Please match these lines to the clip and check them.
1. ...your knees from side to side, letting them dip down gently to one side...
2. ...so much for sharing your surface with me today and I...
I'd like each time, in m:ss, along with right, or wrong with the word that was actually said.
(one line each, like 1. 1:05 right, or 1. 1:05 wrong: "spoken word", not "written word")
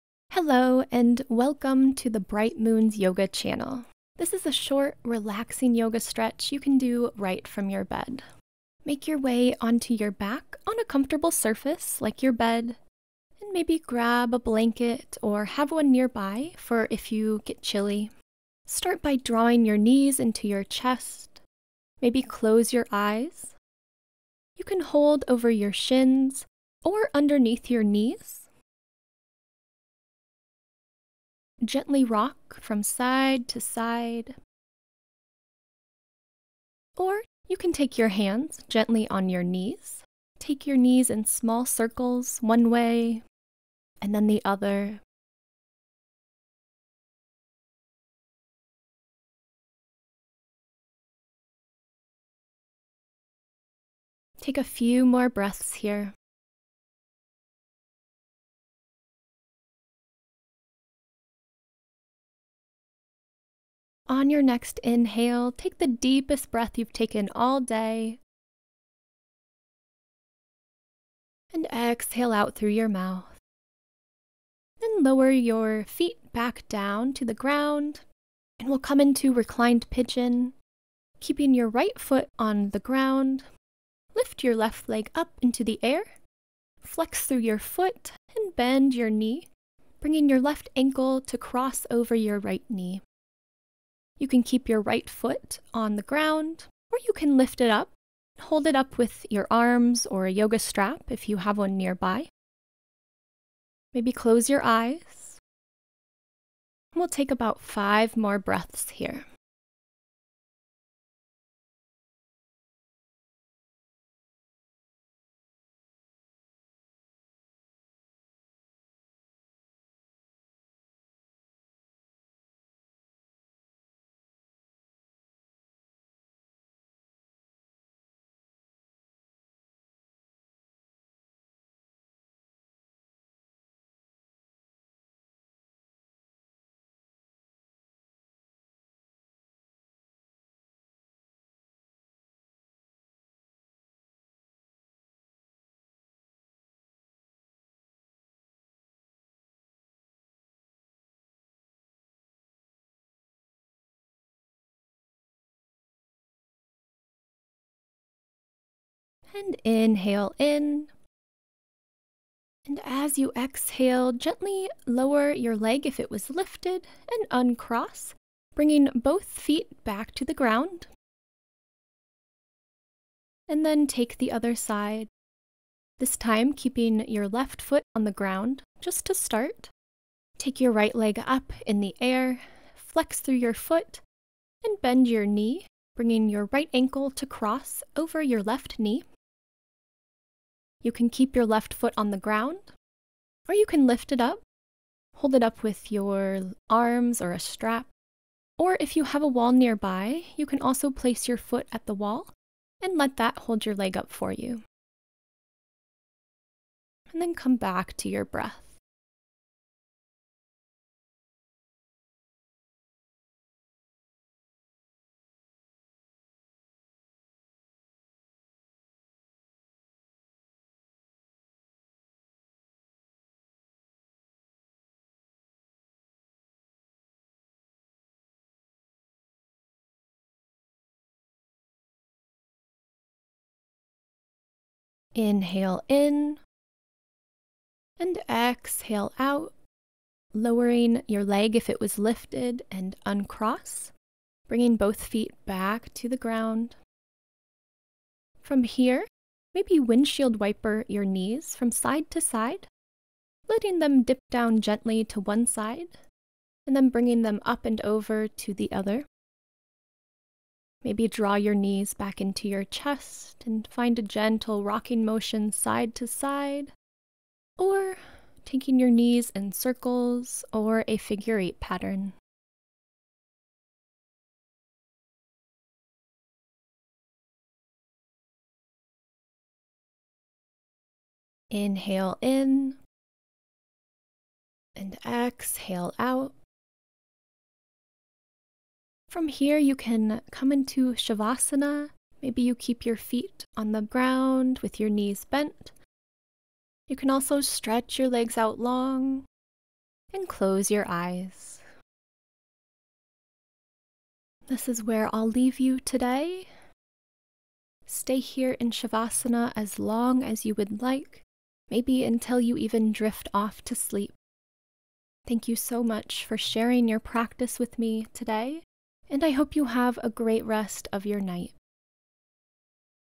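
1. 4:10 right
2. 5:15 wrong: "practice", not "surface".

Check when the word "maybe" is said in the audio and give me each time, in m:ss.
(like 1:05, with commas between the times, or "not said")
0:13, 0:22, 1:43, 4:09, 4:20, 4:52, 5:11.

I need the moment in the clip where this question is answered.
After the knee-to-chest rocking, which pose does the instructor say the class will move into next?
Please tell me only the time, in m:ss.
1:19.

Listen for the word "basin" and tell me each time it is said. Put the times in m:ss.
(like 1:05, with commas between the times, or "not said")
not said.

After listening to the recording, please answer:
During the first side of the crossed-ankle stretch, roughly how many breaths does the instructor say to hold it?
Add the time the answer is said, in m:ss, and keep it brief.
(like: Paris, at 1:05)
5, at 1:47.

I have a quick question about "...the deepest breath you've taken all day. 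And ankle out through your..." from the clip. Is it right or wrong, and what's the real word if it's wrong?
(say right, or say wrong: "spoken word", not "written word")
wrong: "exhale", not "ankle".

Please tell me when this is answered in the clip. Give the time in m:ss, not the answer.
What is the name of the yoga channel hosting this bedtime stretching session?
0:02.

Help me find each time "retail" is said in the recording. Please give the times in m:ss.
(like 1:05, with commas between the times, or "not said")
not said.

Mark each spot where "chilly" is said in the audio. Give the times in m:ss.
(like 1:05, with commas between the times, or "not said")
0:17.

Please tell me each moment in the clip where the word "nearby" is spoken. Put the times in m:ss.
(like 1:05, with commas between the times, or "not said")
0:15, 1:41, 3:19.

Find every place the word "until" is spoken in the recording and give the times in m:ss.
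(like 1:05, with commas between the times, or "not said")
5:12.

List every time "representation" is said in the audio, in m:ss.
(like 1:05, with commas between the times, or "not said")
not said.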